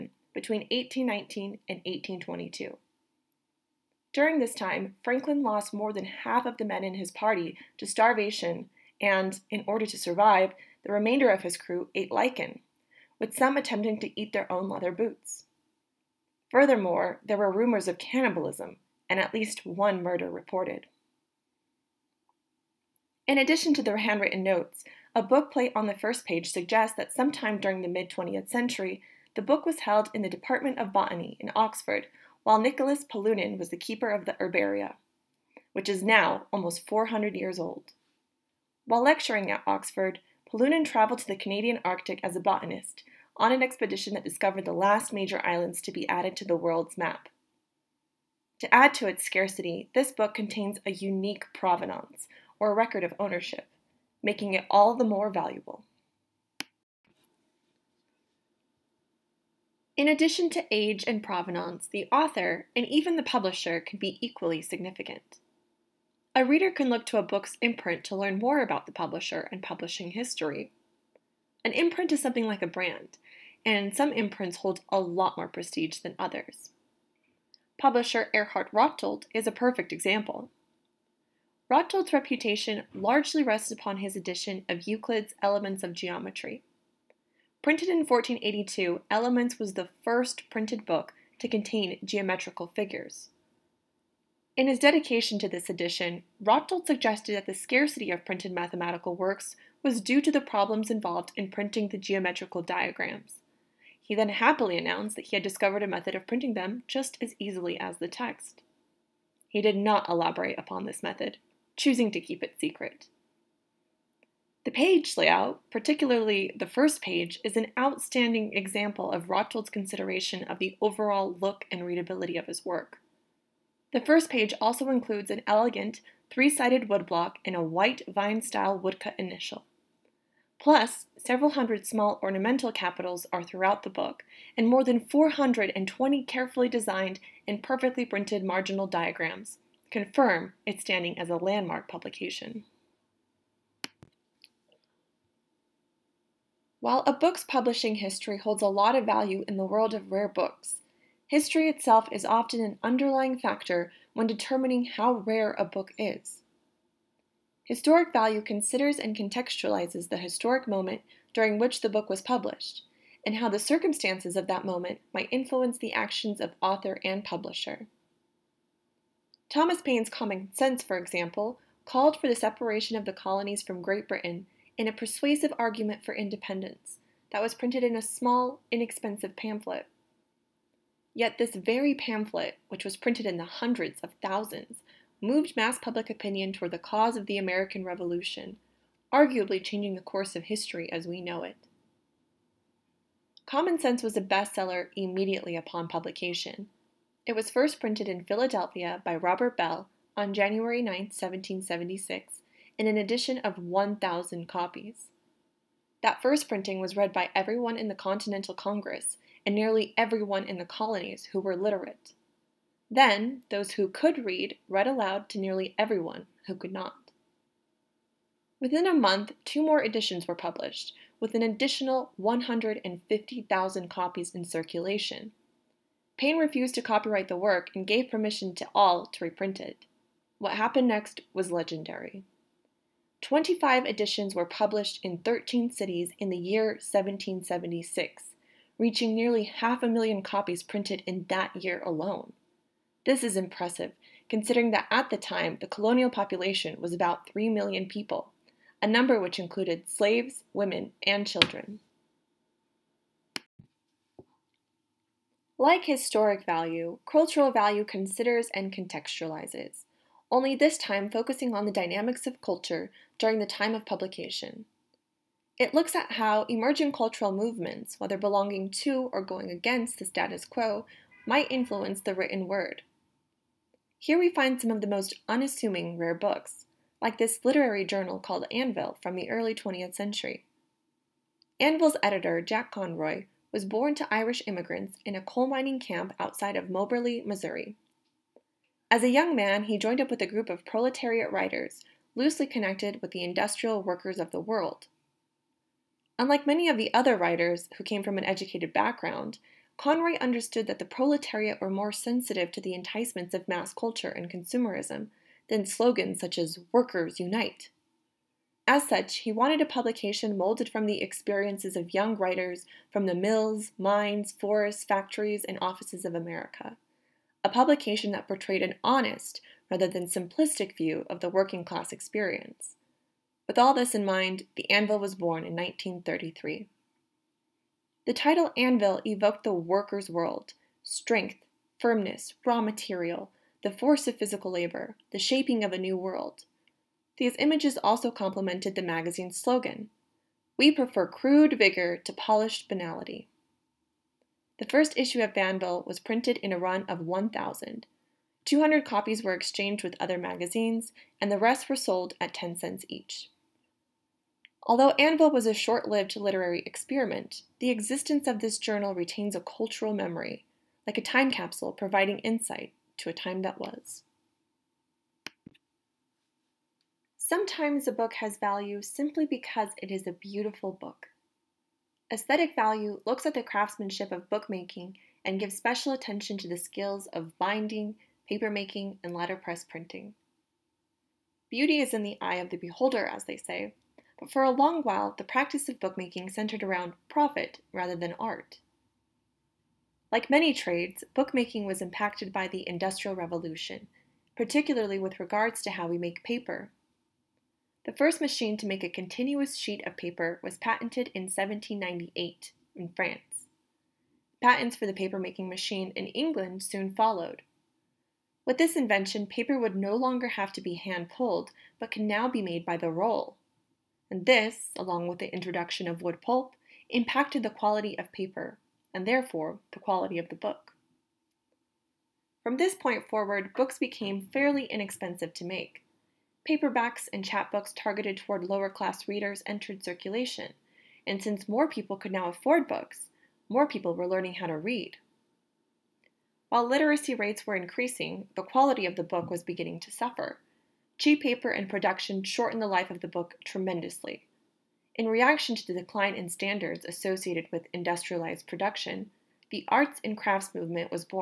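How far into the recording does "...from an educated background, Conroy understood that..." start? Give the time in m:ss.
4:58.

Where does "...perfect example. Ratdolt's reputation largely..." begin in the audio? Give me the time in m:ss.
1:19.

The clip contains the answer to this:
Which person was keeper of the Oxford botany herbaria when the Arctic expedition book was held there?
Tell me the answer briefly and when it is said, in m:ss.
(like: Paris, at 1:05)
Nicholas Polunin, at 0:32.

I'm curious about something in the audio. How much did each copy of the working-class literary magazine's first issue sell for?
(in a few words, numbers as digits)
10 cents.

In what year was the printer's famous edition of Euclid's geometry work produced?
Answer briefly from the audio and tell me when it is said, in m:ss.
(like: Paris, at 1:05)
1482, at 1:28.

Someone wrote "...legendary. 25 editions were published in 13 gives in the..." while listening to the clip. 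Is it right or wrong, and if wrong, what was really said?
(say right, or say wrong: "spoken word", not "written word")
wrong: "cities", not "gives".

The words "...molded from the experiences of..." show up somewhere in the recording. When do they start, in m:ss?
5:10.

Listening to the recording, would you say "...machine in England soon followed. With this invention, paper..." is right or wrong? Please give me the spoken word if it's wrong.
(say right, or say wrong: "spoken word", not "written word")
right.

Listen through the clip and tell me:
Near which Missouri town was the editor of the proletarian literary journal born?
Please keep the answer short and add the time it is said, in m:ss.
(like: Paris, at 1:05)
Moberly, at 4:46.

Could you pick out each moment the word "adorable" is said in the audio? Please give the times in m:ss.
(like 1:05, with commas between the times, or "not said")
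not said.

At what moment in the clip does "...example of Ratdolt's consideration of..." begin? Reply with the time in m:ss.
1:58.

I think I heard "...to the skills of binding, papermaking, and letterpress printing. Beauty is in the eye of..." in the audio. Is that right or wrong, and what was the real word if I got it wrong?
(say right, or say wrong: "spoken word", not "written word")
right.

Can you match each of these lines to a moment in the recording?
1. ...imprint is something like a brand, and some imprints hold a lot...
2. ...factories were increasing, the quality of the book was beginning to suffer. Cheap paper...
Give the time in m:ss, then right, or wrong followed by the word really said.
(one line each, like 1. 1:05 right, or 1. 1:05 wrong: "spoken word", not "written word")
1. 1:11 right
2. 7:17 wrong: "rates", not "factories".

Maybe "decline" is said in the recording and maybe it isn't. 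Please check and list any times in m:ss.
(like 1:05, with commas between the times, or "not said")
7:25.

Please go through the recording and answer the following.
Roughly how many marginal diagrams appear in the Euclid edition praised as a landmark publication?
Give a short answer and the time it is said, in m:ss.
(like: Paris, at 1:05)
420, at 2:14.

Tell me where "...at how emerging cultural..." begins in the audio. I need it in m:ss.
4:25.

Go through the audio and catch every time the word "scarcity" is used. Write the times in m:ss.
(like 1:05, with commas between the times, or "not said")
0:49, 1:37.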